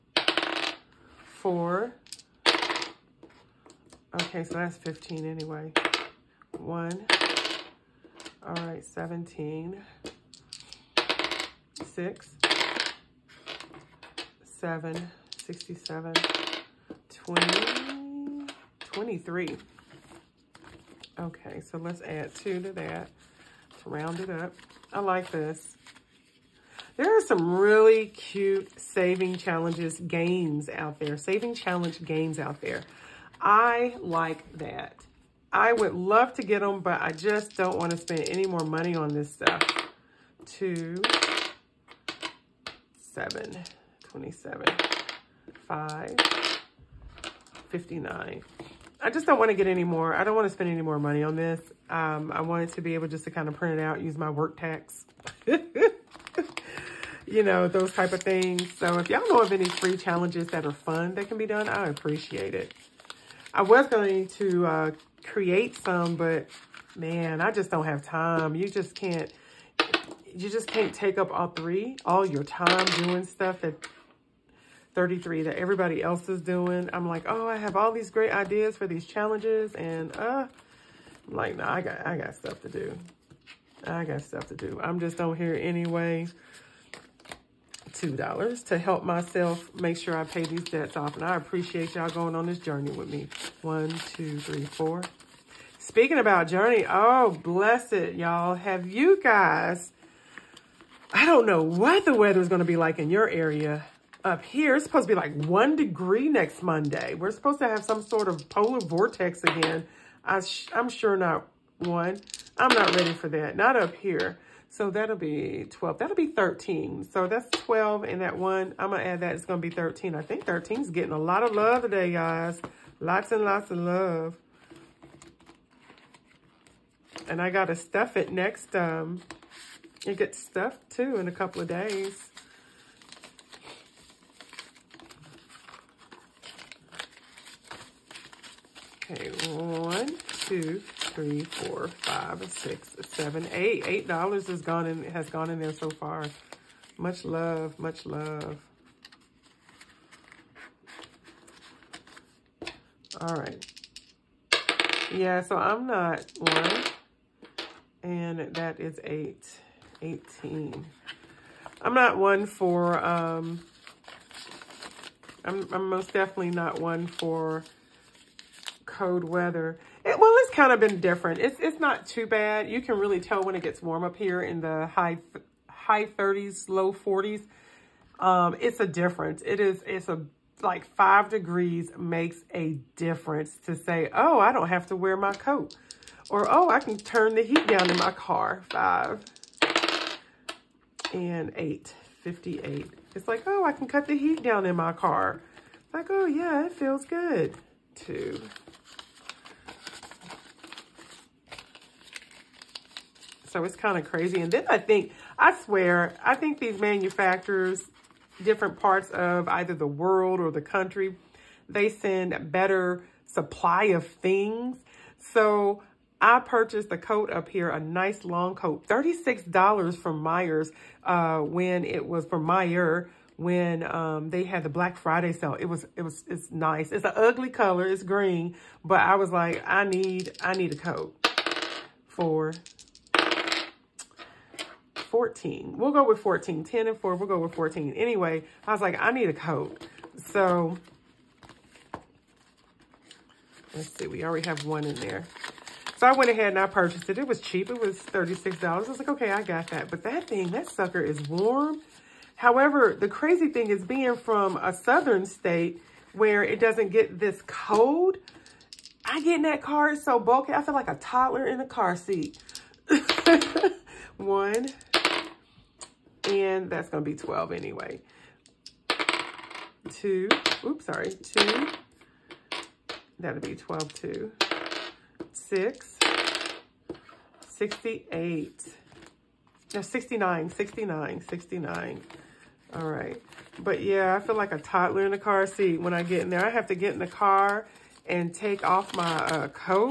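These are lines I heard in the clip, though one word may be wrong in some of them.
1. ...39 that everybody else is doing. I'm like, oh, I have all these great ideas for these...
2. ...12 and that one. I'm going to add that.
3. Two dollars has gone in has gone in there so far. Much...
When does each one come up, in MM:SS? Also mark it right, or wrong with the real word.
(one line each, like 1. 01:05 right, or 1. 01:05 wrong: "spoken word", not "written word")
1. 01:14 wrong: "33", not "39"
2. 01:57 right
3. 02:23 wrong: "Eight", not "Two".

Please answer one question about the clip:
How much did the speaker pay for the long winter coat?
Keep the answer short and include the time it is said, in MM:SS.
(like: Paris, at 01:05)
$36, at 03:38.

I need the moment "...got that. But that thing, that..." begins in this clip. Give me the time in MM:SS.
04:09.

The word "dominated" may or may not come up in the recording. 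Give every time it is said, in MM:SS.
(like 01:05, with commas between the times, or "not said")
not said.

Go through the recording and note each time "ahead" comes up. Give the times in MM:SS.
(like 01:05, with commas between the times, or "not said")
04:06.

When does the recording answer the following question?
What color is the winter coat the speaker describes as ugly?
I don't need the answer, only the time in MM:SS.
03:47.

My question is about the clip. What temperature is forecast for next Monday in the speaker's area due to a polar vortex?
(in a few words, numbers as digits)
1 degree.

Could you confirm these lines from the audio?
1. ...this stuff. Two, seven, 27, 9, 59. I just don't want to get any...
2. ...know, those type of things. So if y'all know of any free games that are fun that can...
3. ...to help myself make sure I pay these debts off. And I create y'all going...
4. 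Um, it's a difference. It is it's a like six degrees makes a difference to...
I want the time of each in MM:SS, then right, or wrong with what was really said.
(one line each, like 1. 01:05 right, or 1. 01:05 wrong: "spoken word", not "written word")
1. 00:39 wrong: "5", not "9"
2. 00:57 wrong: "challenges", not "games"
3. 01:28 wrong: "appreciate", not "create"
4. 02:58 wrong: "five", not "six".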